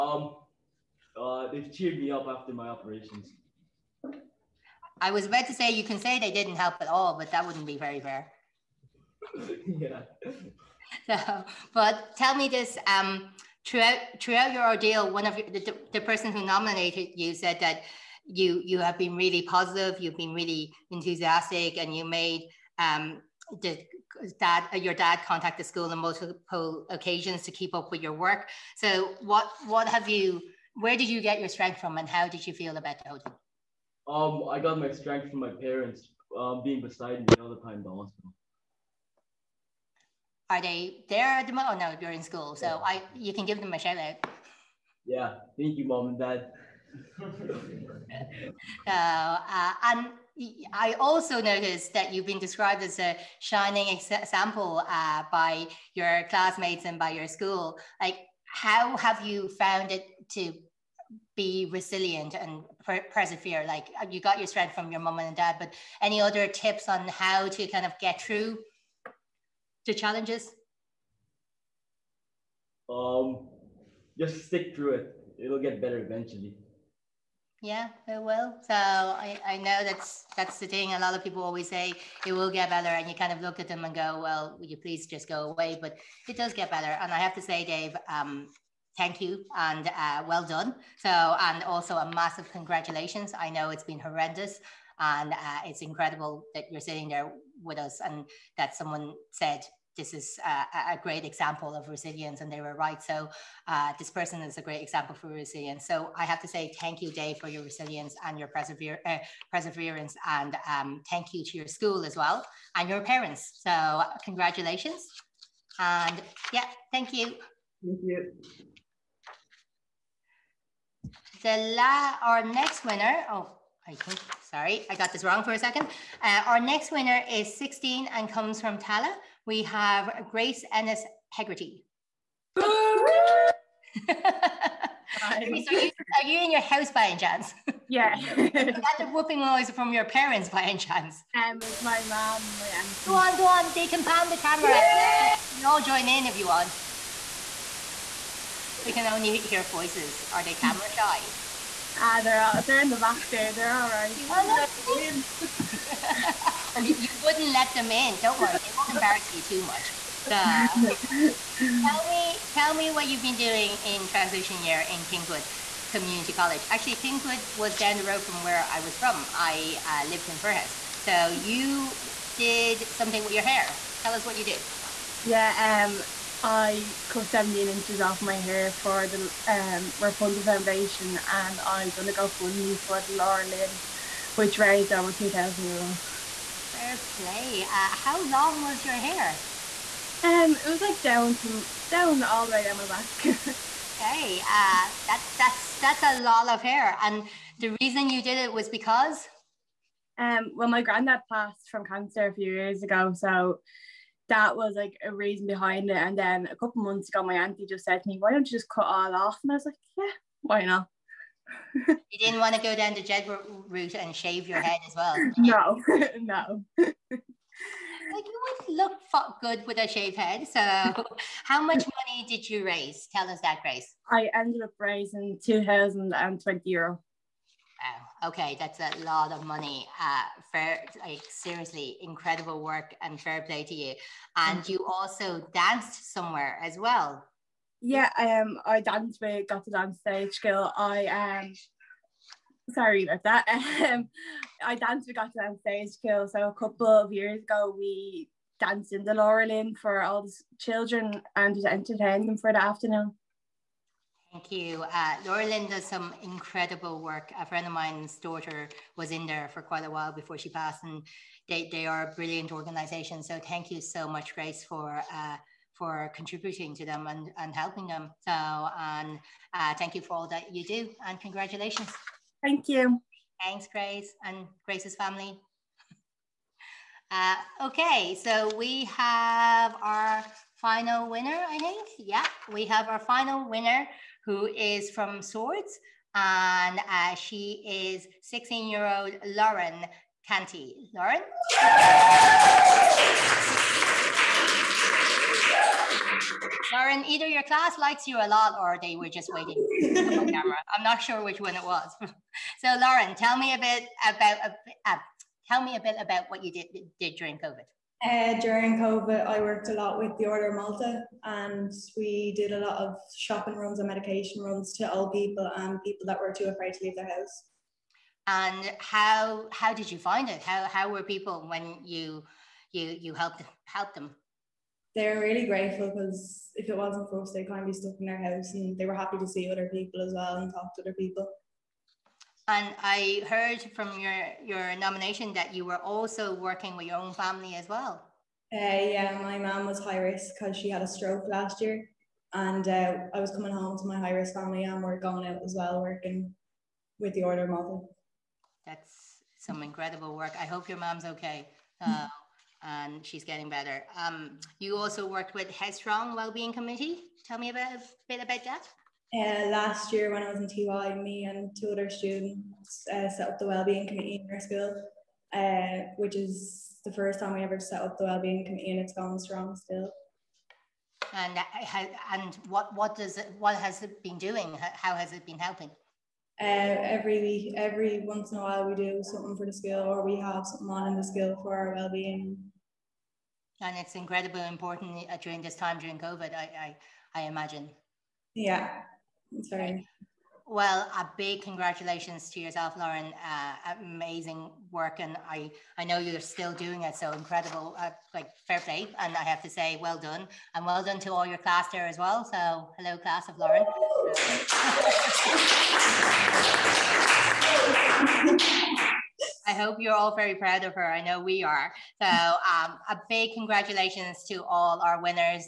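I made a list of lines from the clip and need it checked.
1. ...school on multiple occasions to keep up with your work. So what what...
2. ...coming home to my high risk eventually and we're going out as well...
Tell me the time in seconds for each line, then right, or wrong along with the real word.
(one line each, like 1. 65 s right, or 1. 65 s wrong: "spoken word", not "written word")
1. 25 s right
2. 343 s wrong: "family", not "eventually".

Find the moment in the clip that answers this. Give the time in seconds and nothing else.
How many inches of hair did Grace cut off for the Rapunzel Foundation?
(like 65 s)
177 s.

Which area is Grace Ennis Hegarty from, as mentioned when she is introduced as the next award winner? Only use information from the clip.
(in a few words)
Tallaght.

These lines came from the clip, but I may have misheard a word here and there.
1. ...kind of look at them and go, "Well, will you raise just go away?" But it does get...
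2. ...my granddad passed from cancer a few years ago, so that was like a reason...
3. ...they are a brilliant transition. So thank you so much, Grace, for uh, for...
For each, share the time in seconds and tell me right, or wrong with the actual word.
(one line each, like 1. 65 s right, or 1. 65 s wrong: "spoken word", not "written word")
1. 83 s wrong: "please", not "raise"
2. 200 s right
3. 261 s wrong: "organization", not "transition".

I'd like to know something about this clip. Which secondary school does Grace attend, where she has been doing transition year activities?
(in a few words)
Kingswood Community College.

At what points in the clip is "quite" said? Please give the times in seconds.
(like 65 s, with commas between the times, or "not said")
259 s.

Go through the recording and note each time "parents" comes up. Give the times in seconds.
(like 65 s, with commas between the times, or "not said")
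35 s, 113 s, 140 s.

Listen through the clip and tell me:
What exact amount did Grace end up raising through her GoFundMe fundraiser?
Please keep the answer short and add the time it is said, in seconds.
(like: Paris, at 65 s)
2,020 euro, at 225 s.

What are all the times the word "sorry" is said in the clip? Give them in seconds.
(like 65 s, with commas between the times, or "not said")
124 s, 242 s, 389 s.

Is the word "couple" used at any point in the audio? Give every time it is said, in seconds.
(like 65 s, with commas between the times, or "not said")
206 s, 246 s.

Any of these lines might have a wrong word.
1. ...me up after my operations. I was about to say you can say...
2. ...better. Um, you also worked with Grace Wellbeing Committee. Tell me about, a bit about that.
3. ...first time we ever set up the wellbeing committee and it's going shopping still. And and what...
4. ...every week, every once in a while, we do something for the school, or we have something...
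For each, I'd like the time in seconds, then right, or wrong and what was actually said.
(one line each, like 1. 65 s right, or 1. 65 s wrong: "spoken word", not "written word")
1. 1 s right
2. 353 s wrong: "Headstrong", not "Grace"
3. 366 s wrong: "strong", not "shopping"
4. 376 s right.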